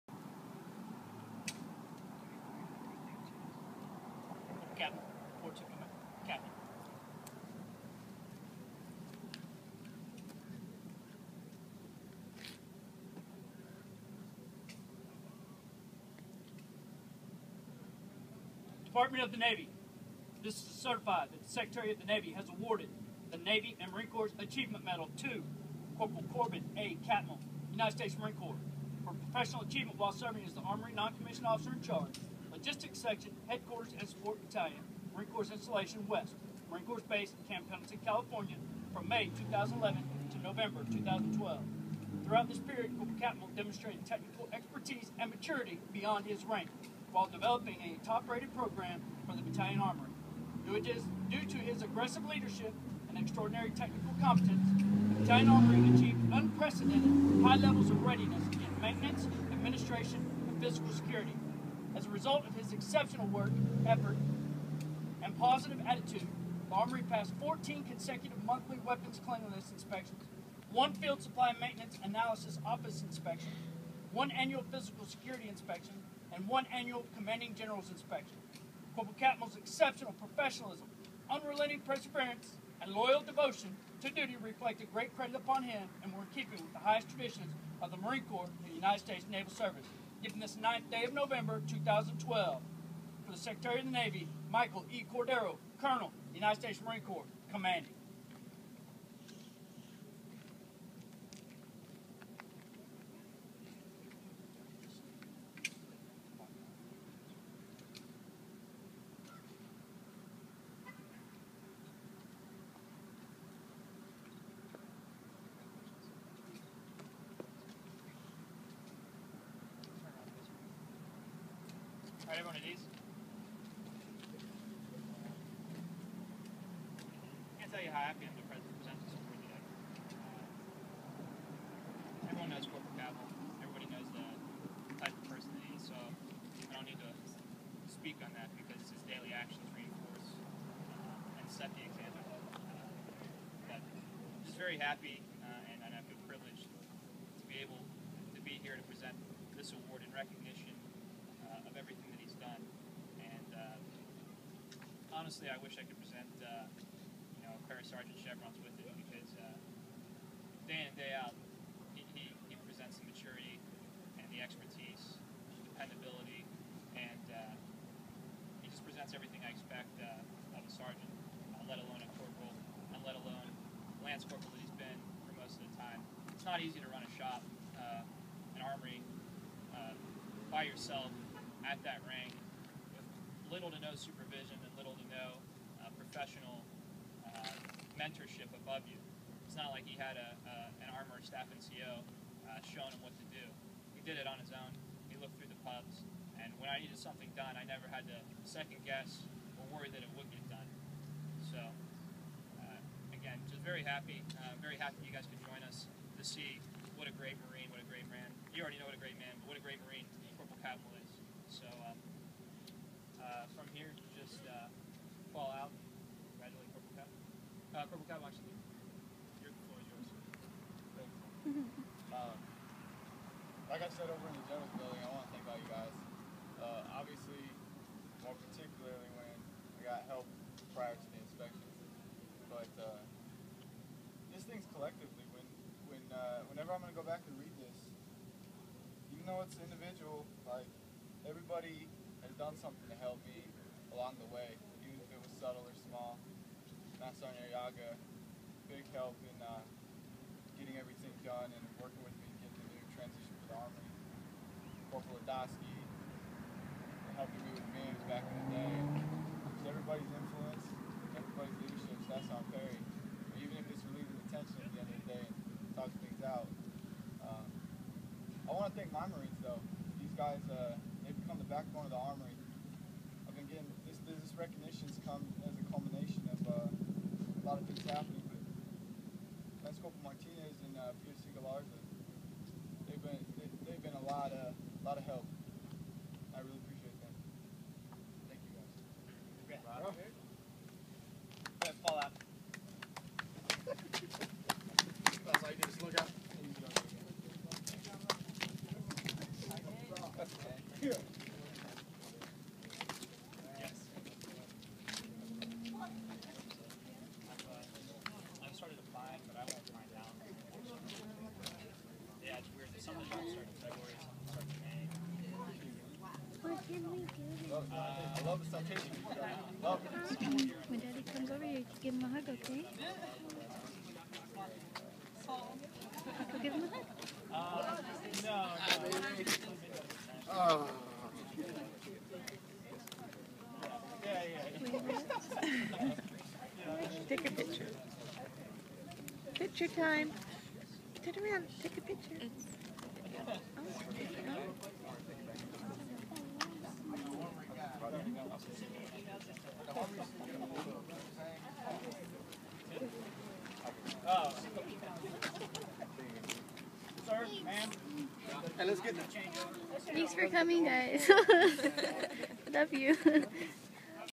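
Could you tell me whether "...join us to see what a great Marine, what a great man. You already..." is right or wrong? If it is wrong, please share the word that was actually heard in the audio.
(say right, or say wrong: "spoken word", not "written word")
right.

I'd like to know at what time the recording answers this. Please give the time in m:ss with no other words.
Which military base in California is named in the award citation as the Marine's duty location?
0:37.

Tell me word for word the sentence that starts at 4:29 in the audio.
These guys, uh, they've become the backbone of the Armory.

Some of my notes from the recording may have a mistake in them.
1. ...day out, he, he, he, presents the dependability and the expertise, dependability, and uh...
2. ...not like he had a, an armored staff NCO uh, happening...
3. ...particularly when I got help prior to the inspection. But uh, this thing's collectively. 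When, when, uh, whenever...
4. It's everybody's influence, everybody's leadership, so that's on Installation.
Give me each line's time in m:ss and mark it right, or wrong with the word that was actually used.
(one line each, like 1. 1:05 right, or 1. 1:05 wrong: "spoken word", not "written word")
1. 2:40 wrong: "maturity", not "dependability"
2. 3:09 wrong: "showing", not "happening"
3. 3:48 right
4. 4:19 wrong: "Perry", not "Installation".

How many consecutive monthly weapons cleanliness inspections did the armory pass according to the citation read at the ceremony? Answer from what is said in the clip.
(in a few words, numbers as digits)
14.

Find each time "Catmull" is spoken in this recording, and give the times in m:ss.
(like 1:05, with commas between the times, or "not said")
0:27, 0:43, 1:19.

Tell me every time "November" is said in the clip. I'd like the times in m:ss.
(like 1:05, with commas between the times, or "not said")
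0:40, 1:31.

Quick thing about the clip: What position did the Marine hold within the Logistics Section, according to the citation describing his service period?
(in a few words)
Armory Non-Commissioned Officer in Charge.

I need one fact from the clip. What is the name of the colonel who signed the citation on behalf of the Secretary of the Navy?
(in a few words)
Michael E. Cordero.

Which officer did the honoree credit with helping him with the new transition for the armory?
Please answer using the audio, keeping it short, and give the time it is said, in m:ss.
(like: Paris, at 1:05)
Master Ariaga, at 4:07.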